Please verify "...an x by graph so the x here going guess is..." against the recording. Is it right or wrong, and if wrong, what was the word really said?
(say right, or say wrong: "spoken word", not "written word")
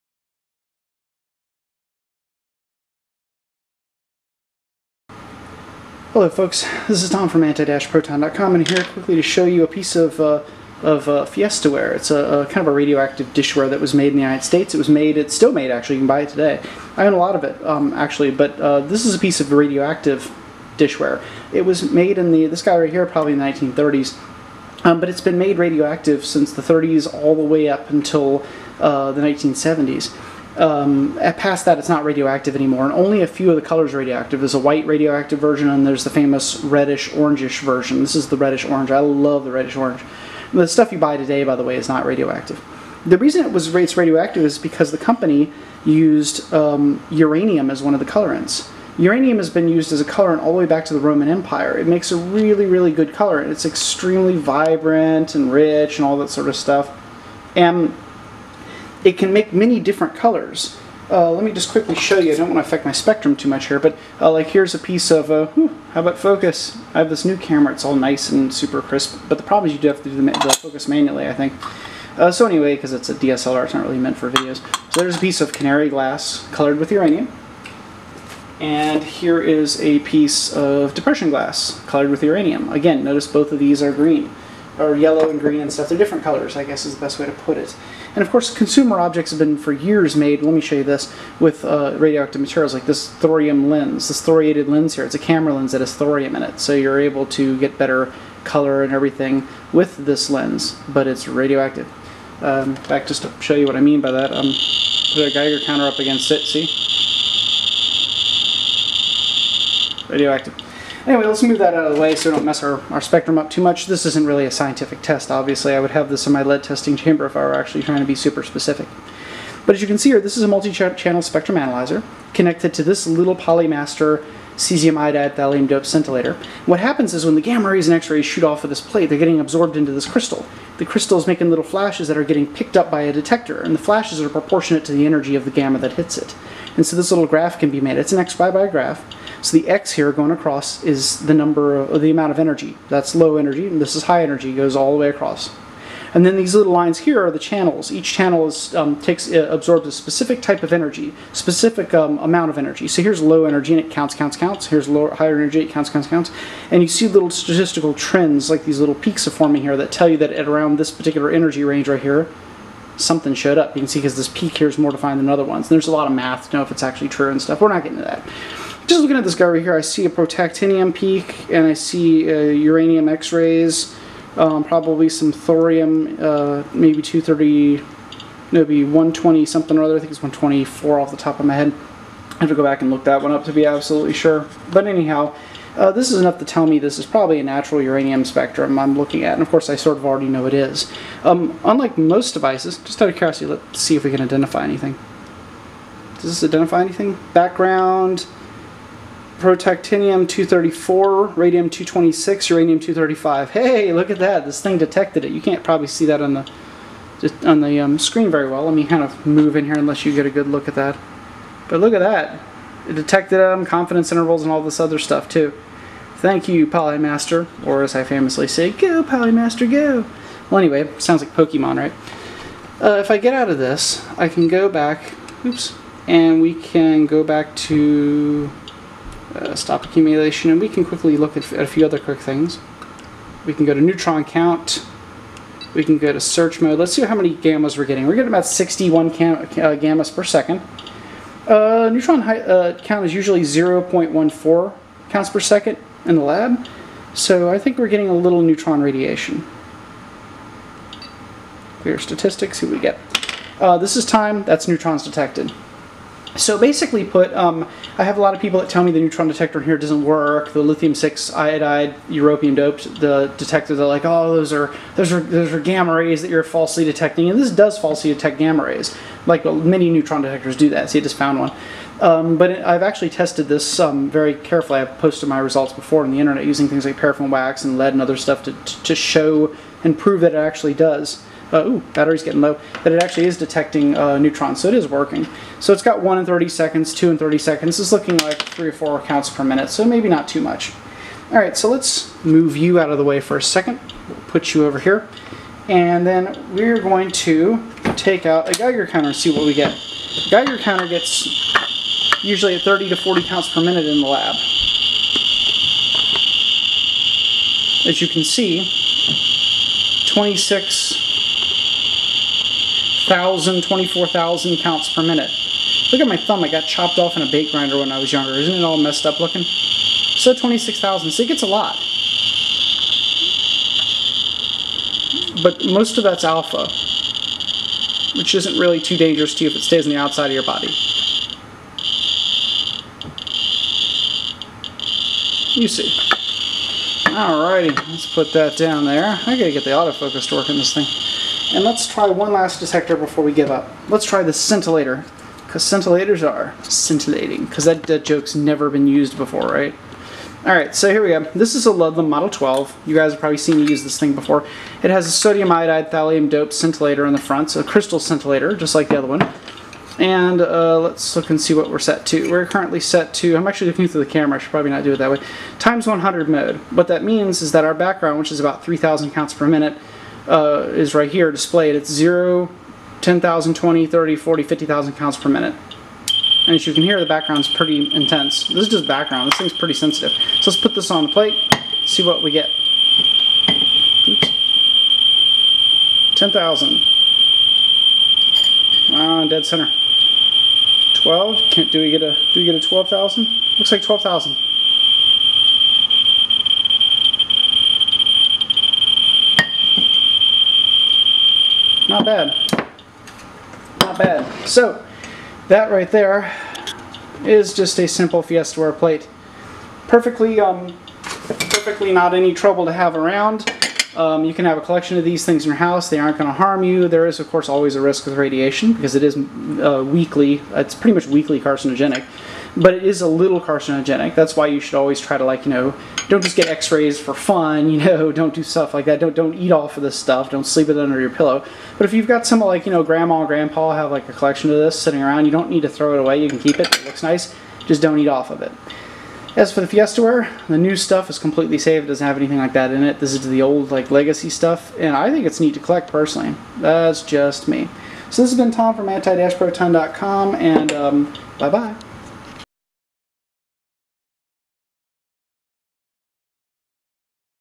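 wrong: "across", not "guess".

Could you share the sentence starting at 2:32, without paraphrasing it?
So here's low energy, and it counts, counts, counts.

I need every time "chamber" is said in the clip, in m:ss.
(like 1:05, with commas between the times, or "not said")
1:56.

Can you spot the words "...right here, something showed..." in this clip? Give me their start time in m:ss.
2:41.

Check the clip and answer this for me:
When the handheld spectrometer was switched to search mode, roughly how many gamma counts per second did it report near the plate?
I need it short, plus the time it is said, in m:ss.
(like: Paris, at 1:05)
61, at 3:58.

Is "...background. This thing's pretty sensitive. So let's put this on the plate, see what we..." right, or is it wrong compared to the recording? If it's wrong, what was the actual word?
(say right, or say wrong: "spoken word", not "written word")
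right.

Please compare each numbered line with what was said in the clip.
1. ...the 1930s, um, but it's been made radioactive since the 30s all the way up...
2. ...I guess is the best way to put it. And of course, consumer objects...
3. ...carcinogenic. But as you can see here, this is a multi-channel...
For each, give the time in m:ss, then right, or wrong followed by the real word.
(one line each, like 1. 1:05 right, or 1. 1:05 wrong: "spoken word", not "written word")
1. 0:23 right
2. 1:26 right
3. 1:58 wrong: "specific", not "carcinogenic".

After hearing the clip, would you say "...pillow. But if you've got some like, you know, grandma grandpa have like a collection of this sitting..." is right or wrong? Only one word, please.
right.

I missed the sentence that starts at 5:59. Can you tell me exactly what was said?
And uh, let's look and see what we're set to.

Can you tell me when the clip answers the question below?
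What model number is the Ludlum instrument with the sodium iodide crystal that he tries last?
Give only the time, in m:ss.
5:52.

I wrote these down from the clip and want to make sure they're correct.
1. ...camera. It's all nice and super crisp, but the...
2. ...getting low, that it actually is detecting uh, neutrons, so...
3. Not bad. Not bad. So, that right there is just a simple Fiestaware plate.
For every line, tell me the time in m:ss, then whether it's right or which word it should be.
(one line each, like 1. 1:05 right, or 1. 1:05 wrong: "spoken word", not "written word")
1. 1:07 right
2. 4:42 right
3. 6:41 right.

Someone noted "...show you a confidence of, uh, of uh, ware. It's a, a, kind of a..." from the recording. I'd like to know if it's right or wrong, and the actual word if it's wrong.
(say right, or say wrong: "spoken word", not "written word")
wrong: "piece", not "confidence".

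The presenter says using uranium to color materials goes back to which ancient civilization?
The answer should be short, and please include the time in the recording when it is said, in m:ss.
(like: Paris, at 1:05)
Roman Empire, at 0:50.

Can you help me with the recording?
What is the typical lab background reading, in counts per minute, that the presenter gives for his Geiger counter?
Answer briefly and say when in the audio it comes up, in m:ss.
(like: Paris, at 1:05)
30 to 40, at 5:02.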